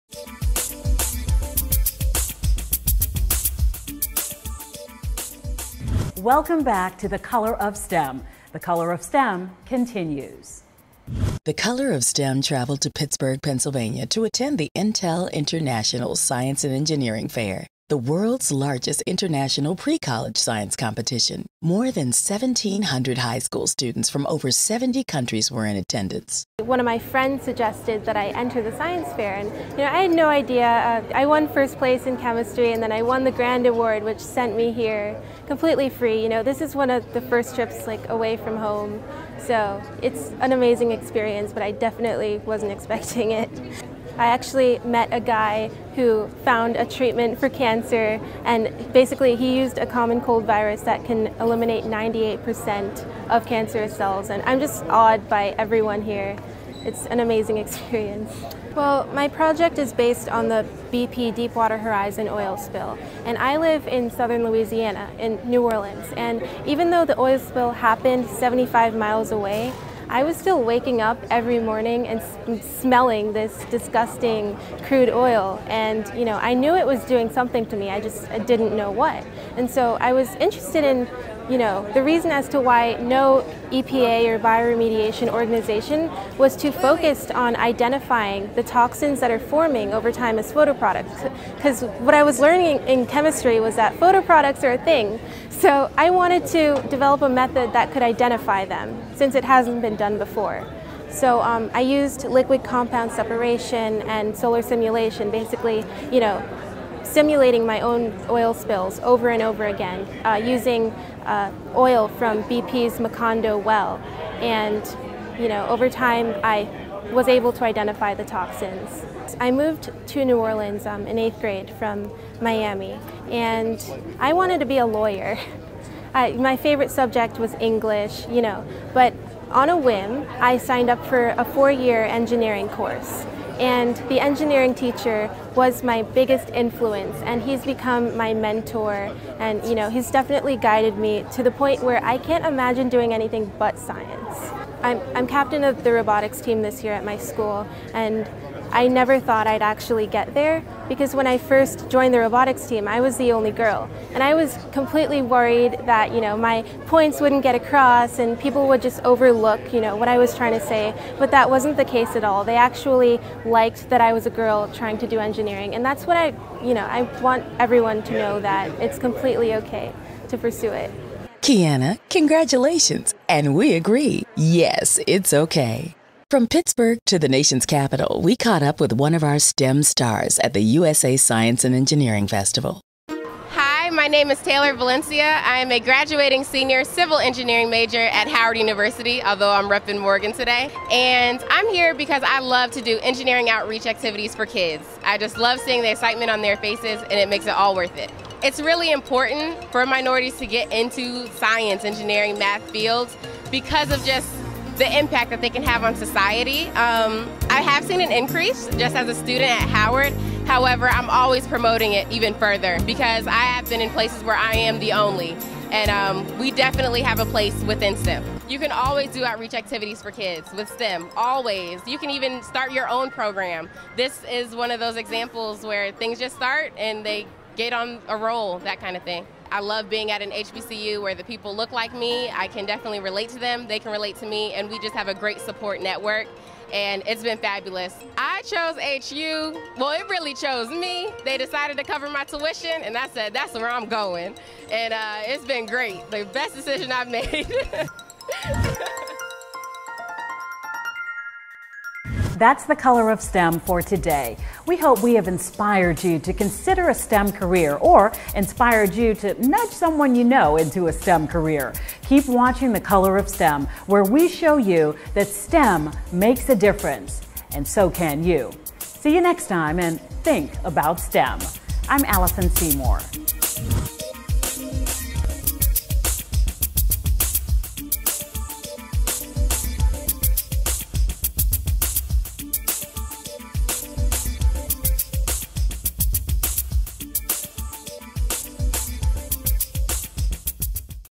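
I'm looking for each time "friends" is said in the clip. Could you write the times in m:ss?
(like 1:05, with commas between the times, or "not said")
0:26.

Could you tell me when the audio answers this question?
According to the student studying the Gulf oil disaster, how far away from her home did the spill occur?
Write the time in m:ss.
1:08.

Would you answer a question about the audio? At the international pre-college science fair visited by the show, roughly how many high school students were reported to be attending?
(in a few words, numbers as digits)
1,700.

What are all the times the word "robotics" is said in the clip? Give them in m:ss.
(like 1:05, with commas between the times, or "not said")
2:25, 2:32.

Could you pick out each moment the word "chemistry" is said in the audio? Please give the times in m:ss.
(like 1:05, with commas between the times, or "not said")
0:32, 1:33.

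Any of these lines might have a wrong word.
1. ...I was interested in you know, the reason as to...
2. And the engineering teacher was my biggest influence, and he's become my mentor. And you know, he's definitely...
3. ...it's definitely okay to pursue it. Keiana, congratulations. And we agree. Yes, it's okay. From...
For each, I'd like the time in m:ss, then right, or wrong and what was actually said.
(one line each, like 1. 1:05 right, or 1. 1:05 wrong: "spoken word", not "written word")
1. 1:20 right
2. 2:13 right
3. 2:48 wrong: "completely", not "definitely".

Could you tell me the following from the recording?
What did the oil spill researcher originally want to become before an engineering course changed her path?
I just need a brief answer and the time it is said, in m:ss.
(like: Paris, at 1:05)
A lawyer, at 2:04.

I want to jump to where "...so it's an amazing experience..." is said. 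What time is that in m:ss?
0:39.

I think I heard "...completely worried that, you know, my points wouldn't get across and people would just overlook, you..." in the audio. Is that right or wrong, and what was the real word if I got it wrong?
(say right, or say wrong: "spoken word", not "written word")
right.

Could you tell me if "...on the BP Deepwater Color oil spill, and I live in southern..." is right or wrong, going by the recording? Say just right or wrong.
wrong.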